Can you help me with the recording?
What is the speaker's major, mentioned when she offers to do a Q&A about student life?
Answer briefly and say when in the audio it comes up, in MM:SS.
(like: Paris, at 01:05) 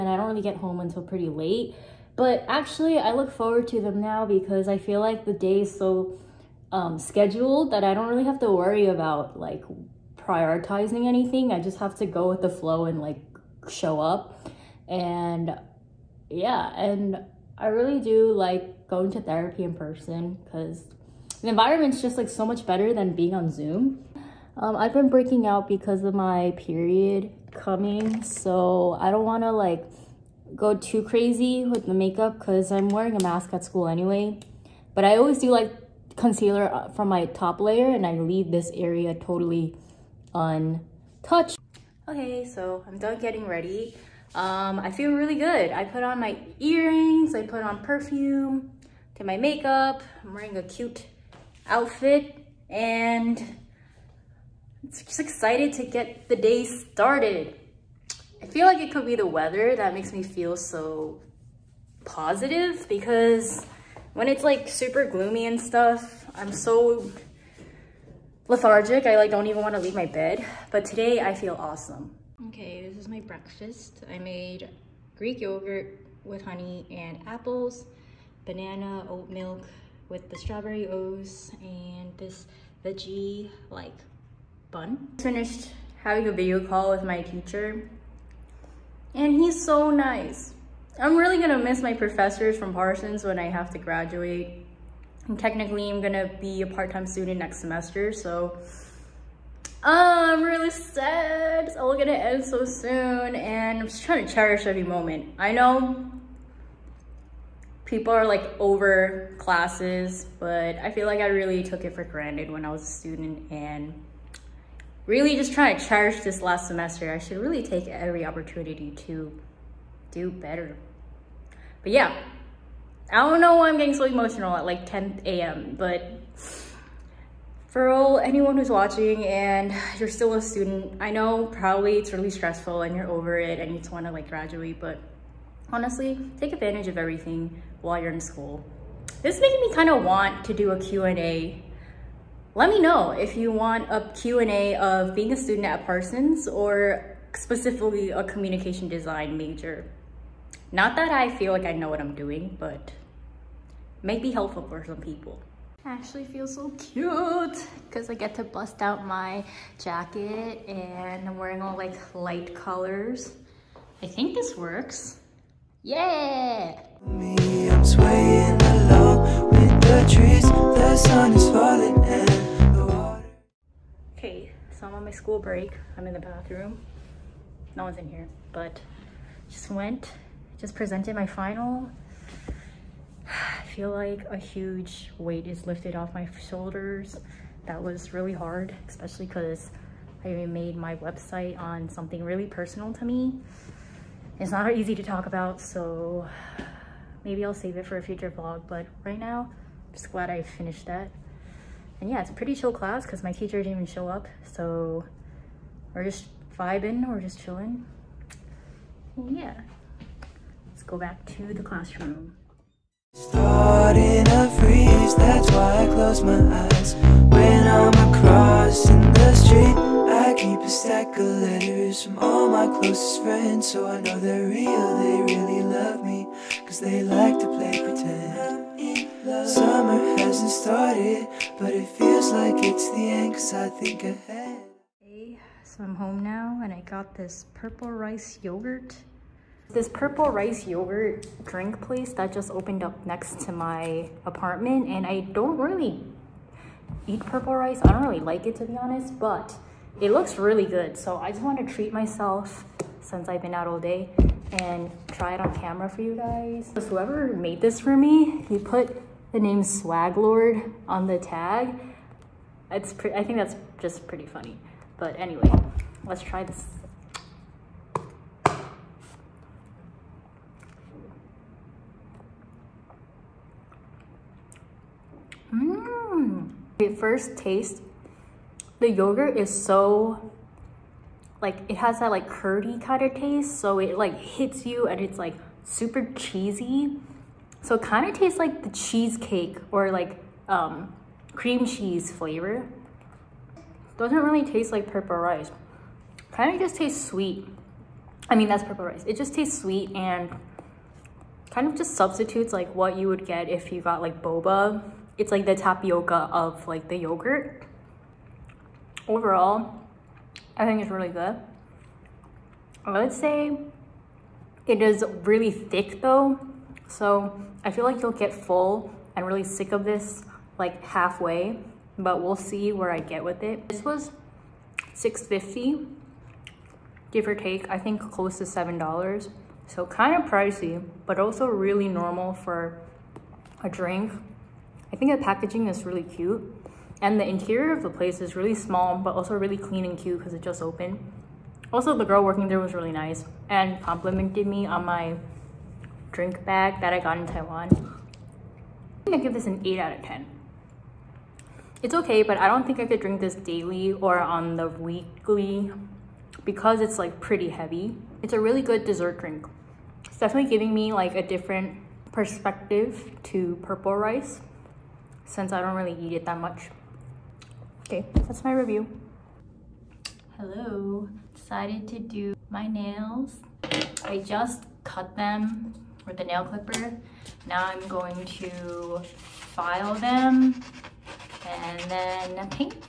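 Communication design, at 02:28.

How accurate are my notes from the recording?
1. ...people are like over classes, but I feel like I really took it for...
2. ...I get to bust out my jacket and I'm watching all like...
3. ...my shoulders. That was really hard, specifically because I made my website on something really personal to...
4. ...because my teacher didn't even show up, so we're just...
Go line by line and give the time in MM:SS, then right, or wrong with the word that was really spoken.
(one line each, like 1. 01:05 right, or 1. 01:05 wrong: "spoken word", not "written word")
1. 01:47 right
2. 02:38 wrong: "wearing", not "watching"
3. 03:06 wrong: "especially", not "specifically"
4. 03:23 right.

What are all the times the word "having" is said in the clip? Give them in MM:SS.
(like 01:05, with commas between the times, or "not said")
01:26.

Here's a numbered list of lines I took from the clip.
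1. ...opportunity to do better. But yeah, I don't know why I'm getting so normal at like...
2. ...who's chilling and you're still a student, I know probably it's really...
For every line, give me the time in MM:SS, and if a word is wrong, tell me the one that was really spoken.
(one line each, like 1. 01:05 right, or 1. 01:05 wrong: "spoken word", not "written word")
1. 01:58 wrong: "emotional", not "normal"
2. 02:08 wrong: "watching", not "chilling".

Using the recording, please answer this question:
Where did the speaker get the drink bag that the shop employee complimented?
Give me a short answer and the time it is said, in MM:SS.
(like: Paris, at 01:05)
Taiwan, at 05:47.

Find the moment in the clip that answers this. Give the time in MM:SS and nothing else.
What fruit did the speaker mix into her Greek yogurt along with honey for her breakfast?
01:17.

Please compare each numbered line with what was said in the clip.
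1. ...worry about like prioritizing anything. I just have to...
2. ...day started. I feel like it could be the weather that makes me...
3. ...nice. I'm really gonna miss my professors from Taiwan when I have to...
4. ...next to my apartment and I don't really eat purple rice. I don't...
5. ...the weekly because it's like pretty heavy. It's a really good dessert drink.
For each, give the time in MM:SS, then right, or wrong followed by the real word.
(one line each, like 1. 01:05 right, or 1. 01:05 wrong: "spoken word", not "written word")
1. 00:08 right
2. 00:56 right
3. 01:29 wrong: "Parsons", not "Taiwan"
4. 04:03 right
5. 05:54 right.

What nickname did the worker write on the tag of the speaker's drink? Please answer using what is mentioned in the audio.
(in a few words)
Swag Lord.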